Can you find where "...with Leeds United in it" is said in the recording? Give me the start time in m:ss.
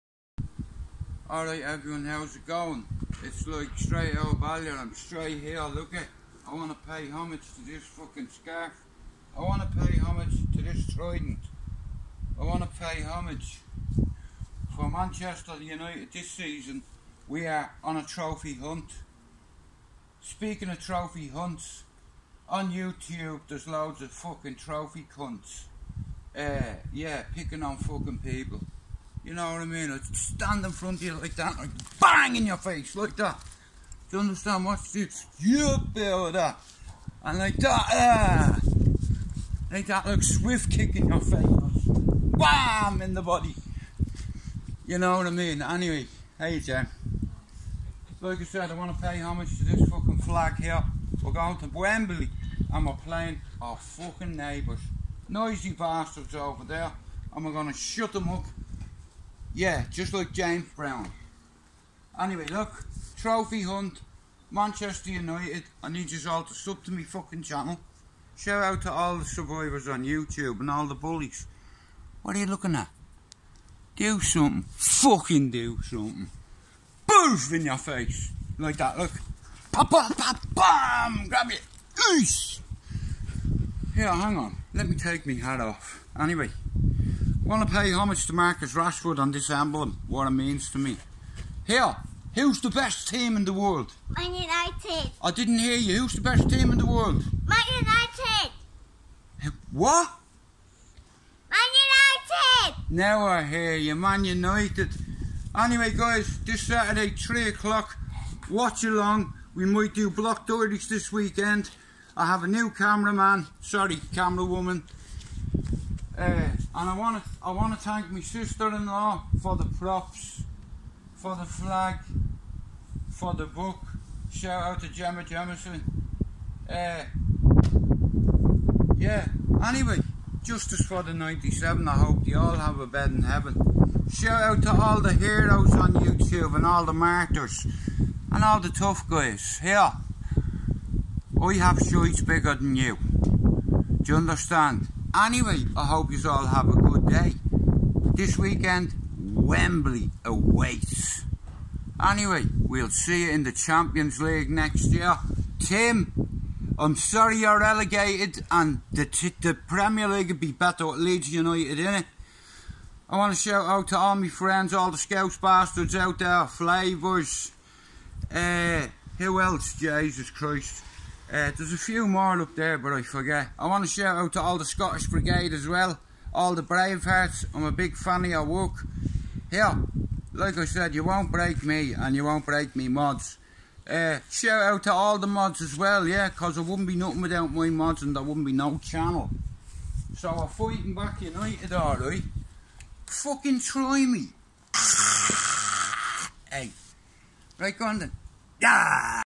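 2:40.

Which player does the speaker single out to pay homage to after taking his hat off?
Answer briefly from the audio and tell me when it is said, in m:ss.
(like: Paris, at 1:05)
Marcus Rashford, at 1:28.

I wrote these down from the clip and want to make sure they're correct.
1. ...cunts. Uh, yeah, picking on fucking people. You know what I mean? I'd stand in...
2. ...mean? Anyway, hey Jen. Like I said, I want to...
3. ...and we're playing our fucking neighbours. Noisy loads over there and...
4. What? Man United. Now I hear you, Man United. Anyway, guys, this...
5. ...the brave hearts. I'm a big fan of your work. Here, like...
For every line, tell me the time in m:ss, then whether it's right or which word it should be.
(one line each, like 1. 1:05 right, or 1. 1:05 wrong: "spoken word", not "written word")
1. 0:25 right
2. 0:45 right
3. 0:52 wrong: "bastards", not "loads"
4. 1:39 right
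5. 2:56 right.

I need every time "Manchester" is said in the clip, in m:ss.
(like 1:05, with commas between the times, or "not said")
0:14, 1:04.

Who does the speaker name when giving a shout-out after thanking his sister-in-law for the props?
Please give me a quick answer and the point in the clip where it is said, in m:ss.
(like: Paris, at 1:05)
Gemma Jemison, at 2:04.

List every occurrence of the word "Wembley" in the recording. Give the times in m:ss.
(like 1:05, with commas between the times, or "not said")
0:51, 2:29.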